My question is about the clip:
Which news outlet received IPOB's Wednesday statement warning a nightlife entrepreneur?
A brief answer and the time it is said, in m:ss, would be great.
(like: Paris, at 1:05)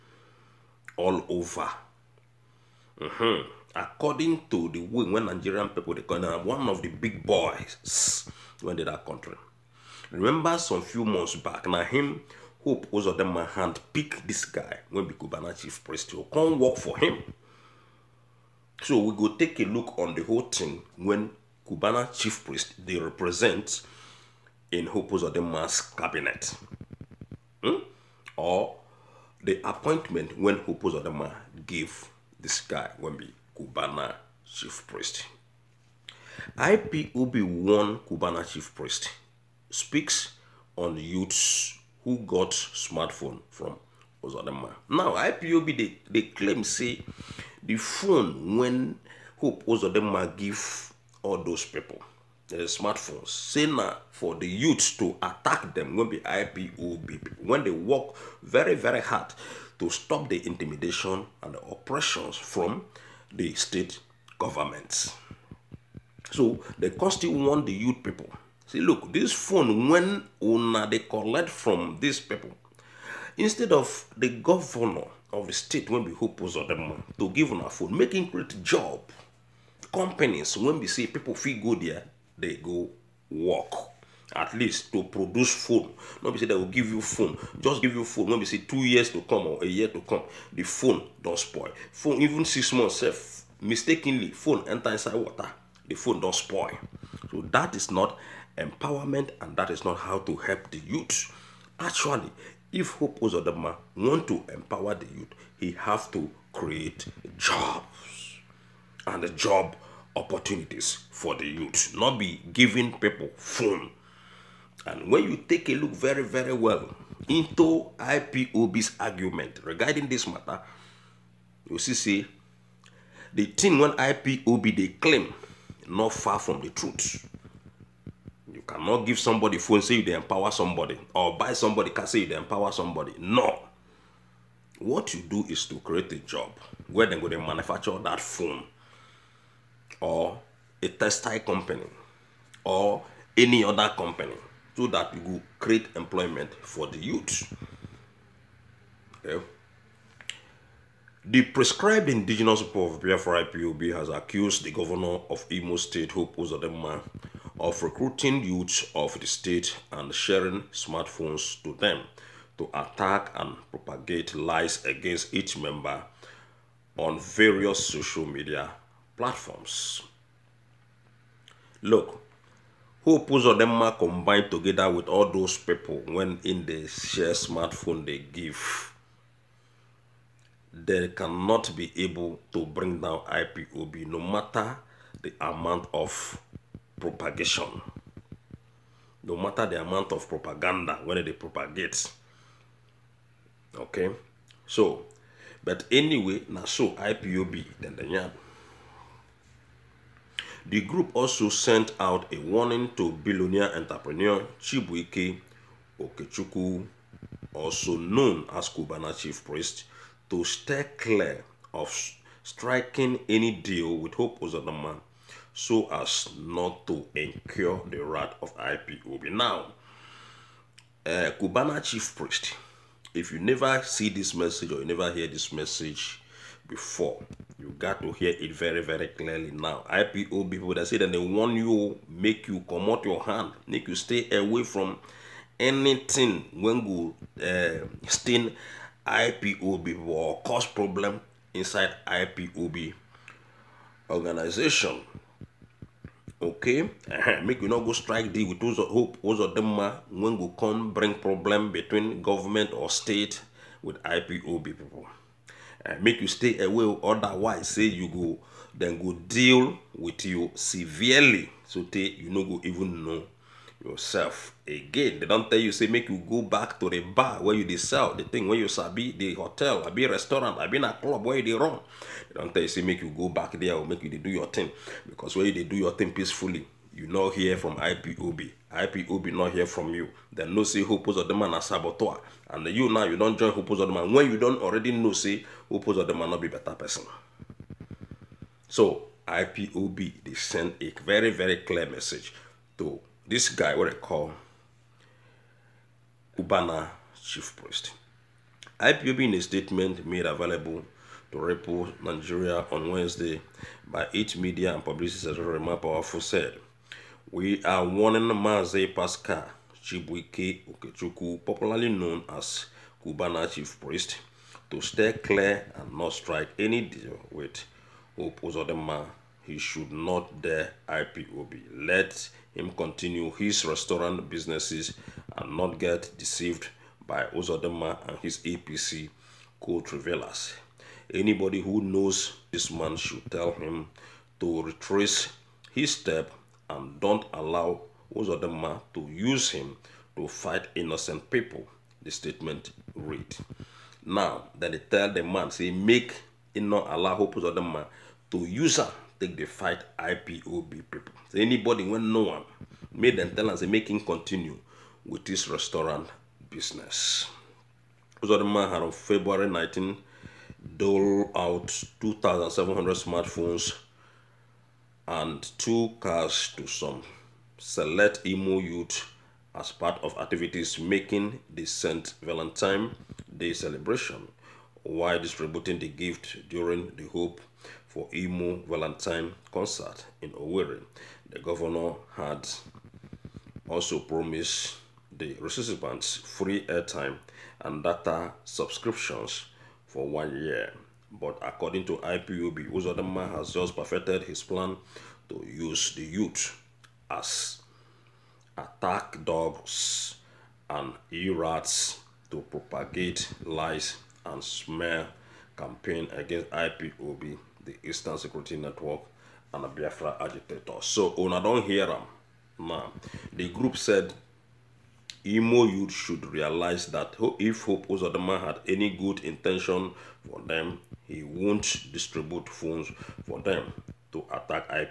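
Repo Nigeria, at 5:01.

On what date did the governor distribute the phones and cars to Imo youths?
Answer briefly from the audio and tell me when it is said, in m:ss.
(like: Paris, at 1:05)
February 19, at 5:58.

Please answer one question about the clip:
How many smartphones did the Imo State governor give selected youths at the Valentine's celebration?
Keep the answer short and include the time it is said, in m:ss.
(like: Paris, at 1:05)
2,700, at 6:01.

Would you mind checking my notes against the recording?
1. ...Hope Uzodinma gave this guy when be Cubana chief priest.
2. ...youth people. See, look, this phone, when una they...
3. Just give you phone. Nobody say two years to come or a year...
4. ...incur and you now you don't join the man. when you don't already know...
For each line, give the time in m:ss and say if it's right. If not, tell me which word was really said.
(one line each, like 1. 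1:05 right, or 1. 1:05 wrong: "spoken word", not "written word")
1. 0:30 right
2. 1:07 right
3. 1:27 right
4. 4:41 wrong: "saboteur", not "incur".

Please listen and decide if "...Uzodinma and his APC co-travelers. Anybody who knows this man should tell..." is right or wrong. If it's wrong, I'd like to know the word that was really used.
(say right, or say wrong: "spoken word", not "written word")
right.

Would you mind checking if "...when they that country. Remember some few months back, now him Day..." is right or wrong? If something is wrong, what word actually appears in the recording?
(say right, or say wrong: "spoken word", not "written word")
wrong: "Hope", not "Day".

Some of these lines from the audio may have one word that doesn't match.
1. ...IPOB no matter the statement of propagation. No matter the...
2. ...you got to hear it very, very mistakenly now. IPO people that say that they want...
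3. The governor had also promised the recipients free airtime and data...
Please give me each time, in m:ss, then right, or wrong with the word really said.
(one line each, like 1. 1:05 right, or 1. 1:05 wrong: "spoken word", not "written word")
1. 3:03 wrong: "amount", not "statement"
2. 3:47 wrong: "clearly", not "mistakenly"
3. 6:21 right.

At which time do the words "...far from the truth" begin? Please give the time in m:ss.
2:06.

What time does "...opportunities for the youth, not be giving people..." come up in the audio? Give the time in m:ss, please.
1:50.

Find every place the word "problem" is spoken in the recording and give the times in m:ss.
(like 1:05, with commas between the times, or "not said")
4:00, 4:11.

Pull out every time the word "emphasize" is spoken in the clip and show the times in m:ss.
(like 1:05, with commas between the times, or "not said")
not said.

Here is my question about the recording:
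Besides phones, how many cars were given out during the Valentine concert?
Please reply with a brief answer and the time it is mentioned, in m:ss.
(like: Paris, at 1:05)
2, at 6:05.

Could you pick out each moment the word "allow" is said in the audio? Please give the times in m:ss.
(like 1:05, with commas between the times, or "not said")
5:37, 5:46.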